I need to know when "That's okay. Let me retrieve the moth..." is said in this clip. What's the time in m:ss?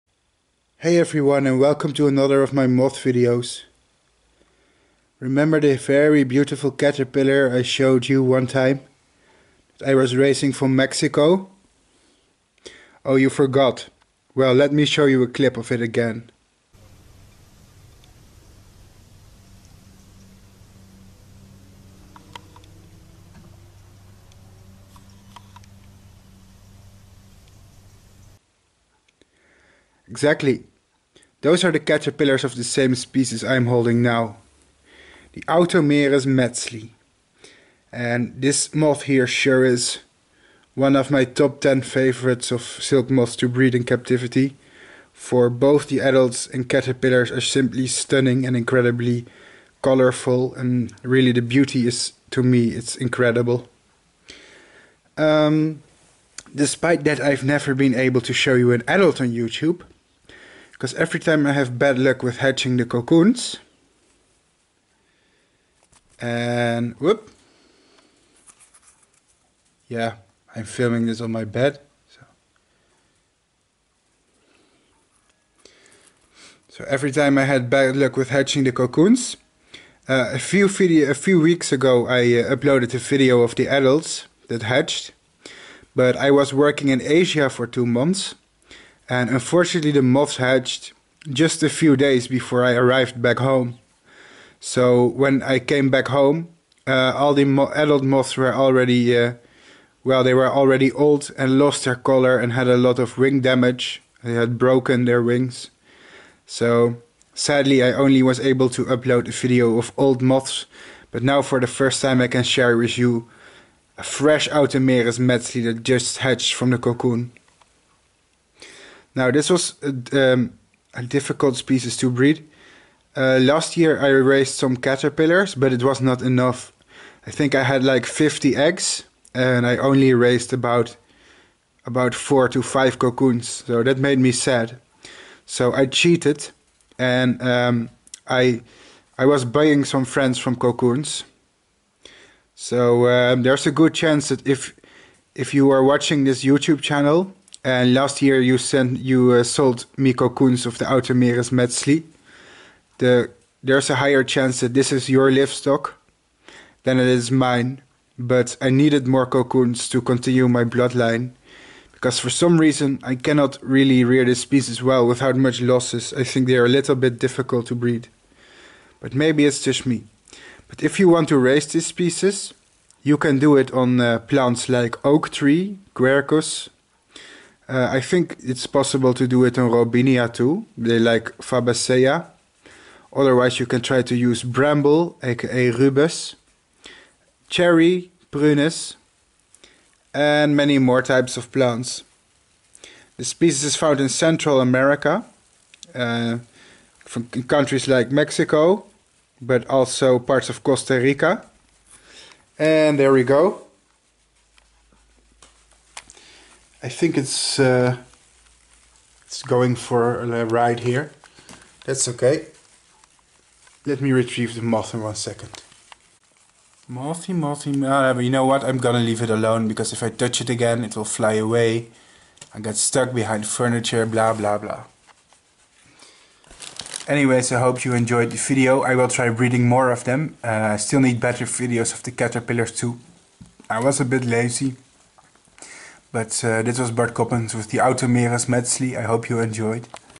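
3:31.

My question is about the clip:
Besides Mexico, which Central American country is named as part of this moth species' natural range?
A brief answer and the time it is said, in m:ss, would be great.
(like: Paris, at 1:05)
Costa Rica, at 3:20.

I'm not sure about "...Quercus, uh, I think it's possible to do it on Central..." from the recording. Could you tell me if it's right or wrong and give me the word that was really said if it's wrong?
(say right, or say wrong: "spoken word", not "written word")
wrong: "Robinia", not "Central".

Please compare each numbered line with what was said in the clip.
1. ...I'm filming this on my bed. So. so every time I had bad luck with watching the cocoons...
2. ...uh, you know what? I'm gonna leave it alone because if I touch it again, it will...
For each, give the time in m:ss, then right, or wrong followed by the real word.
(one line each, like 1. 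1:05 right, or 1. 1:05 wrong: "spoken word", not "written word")
1. 1:10 wrong: "hatching", not "watching"
2. 3:37 right.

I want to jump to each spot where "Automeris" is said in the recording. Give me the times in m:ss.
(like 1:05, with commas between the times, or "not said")
0:35, 1:54, 2:30, 3:57.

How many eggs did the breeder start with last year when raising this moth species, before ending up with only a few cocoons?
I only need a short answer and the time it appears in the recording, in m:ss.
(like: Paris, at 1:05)
50, at 2:08.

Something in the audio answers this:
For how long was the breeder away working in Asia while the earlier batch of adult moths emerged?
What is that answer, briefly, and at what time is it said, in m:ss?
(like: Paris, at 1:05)
two months, at 1:27.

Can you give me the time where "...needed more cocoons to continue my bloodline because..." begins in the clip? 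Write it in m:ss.
2:38.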